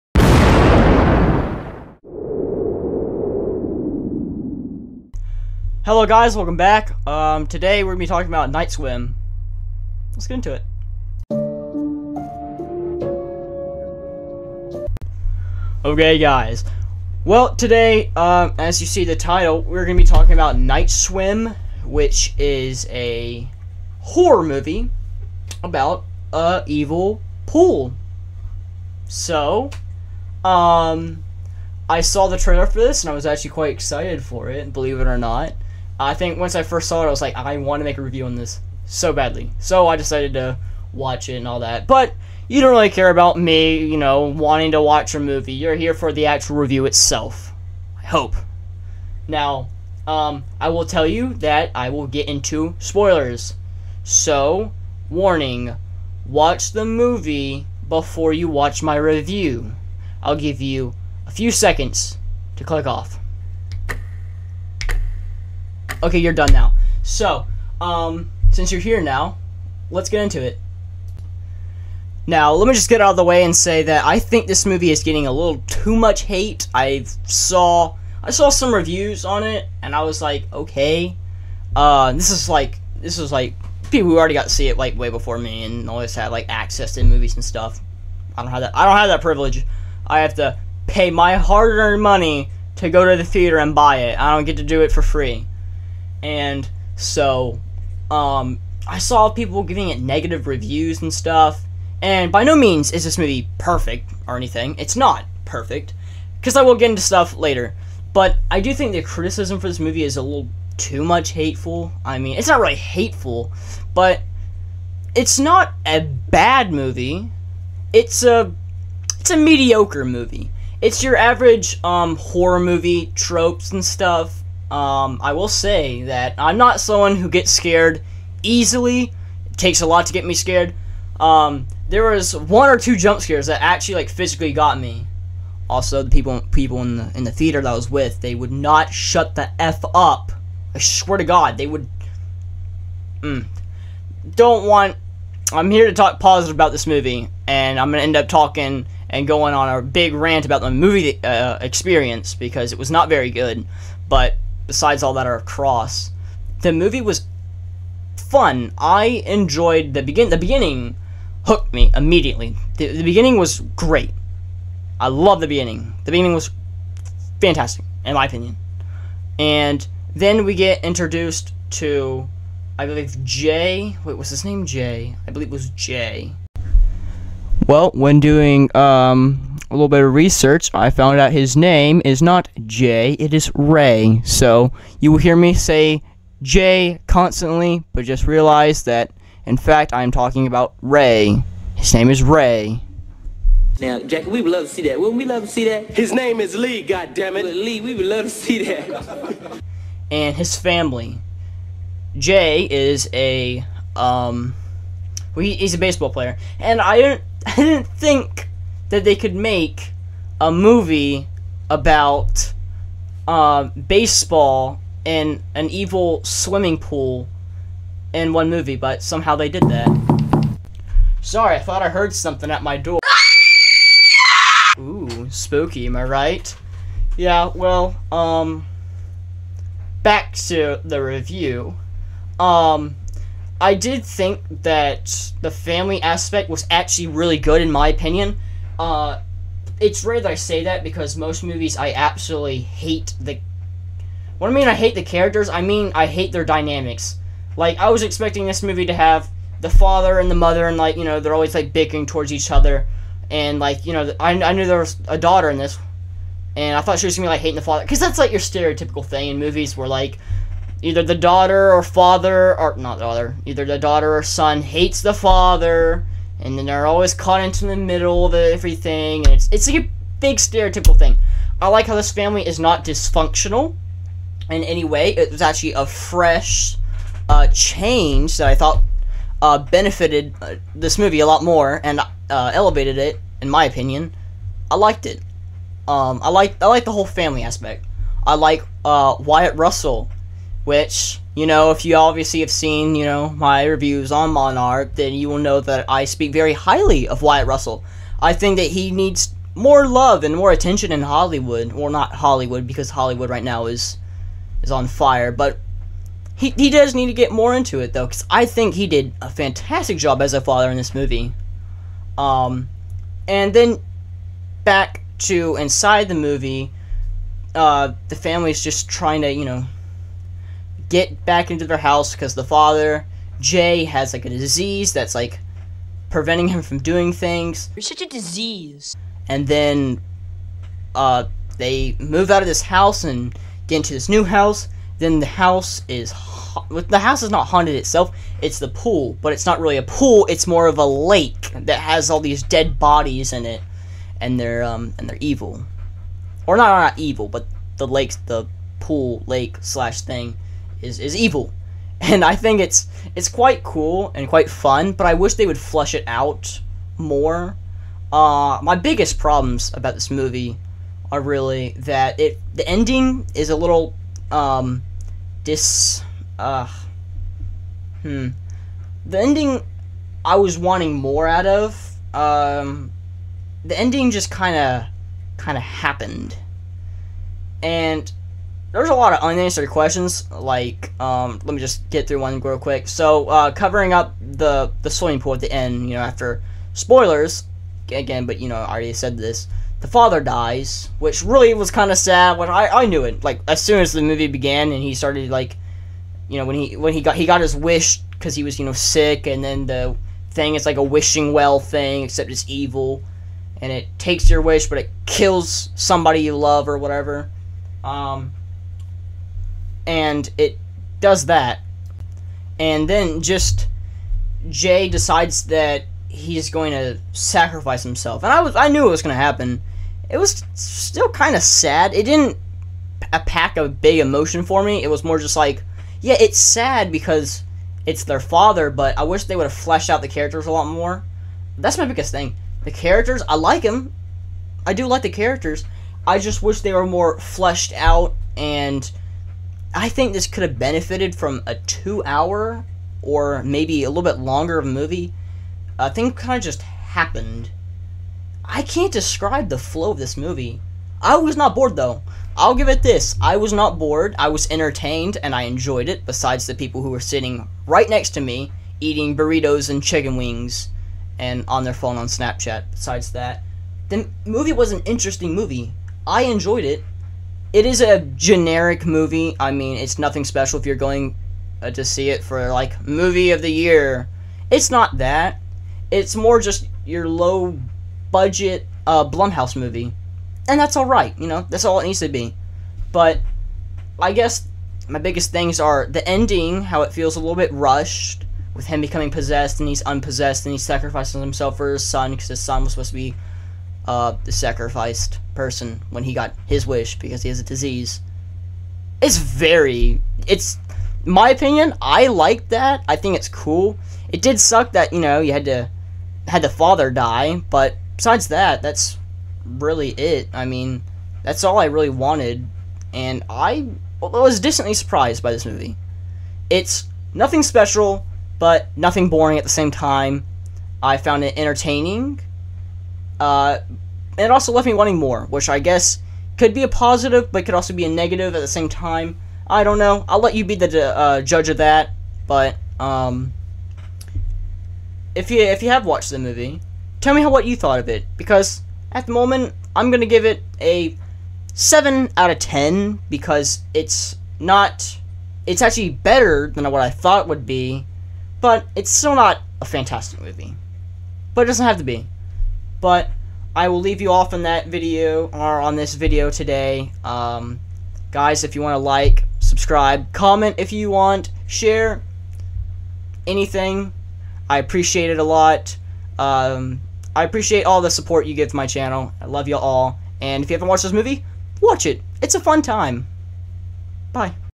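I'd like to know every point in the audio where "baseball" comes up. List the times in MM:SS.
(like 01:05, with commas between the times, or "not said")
03:25, 03:33.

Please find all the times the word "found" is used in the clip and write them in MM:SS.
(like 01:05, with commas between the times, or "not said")
03:00, 08:40.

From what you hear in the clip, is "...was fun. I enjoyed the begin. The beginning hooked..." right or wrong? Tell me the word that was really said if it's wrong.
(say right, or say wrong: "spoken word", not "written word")
right.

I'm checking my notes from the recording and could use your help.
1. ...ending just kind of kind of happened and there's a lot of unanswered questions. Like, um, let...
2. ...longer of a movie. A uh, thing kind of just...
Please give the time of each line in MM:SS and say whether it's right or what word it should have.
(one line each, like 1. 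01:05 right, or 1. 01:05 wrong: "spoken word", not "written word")
1. 06:13 right
2. 07:24 right.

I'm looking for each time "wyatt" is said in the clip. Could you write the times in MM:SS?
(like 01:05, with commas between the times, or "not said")
04:49, 04:57.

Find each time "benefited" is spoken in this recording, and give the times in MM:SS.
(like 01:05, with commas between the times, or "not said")
04:39, 07:20.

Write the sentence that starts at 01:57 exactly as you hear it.
It's a it's a mediocre movie.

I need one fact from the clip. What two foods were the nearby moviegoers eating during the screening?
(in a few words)
Burritos and chicken wings.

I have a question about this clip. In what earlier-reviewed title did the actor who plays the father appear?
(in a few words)
Monarch.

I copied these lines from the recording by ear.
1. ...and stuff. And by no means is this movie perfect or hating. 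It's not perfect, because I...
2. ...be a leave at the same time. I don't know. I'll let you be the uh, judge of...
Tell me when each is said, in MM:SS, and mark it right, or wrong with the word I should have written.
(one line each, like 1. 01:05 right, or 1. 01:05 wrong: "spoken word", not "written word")
1. 01:41 wrong: "anything", not "hating"
2. 08:47 wrong: "negative", not "leave".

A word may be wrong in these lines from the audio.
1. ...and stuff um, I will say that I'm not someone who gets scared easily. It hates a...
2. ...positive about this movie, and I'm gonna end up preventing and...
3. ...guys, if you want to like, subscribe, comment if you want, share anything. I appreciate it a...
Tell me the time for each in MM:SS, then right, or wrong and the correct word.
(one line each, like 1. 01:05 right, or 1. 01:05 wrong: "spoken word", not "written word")
1. 02:03 wrong: "takes", not "hates"
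2. 02:26 wrong: "talking", not "preventing"
3. 09:18 right.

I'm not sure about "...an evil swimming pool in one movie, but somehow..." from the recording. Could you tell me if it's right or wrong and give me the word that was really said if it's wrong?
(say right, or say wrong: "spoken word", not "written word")
right.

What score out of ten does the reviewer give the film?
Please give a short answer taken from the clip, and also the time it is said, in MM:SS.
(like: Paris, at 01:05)
7, at 09:01.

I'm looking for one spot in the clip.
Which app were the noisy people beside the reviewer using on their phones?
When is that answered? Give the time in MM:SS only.
07:42.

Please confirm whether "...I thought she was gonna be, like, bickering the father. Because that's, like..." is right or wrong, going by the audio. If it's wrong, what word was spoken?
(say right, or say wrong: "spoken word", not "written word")
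wrong: "hating", not "bickering".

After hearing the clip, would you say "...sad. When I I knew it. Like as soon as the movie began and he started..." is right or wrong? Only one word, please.
right.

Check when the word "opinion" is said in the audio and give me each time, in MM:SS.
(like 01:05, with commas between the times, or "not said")
02:48, 03:57, 04:43, 08:21.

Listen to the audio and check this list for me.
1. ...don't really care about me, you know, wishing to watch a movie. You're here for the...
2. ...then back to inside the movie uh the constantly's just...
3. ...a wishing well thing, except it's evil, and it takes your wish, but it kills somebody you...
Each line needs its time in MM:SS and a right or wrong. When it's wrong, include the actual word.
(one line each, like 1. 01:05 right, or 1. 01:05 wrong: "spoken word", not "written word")
1. 00:42 wrong: "wanting", not "wishing"
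2. 05:13 wrong: "family", not "constantly"
3. 06:40 right.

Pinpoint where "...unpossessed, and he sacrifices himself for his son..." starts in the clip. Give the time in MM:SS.
08:09.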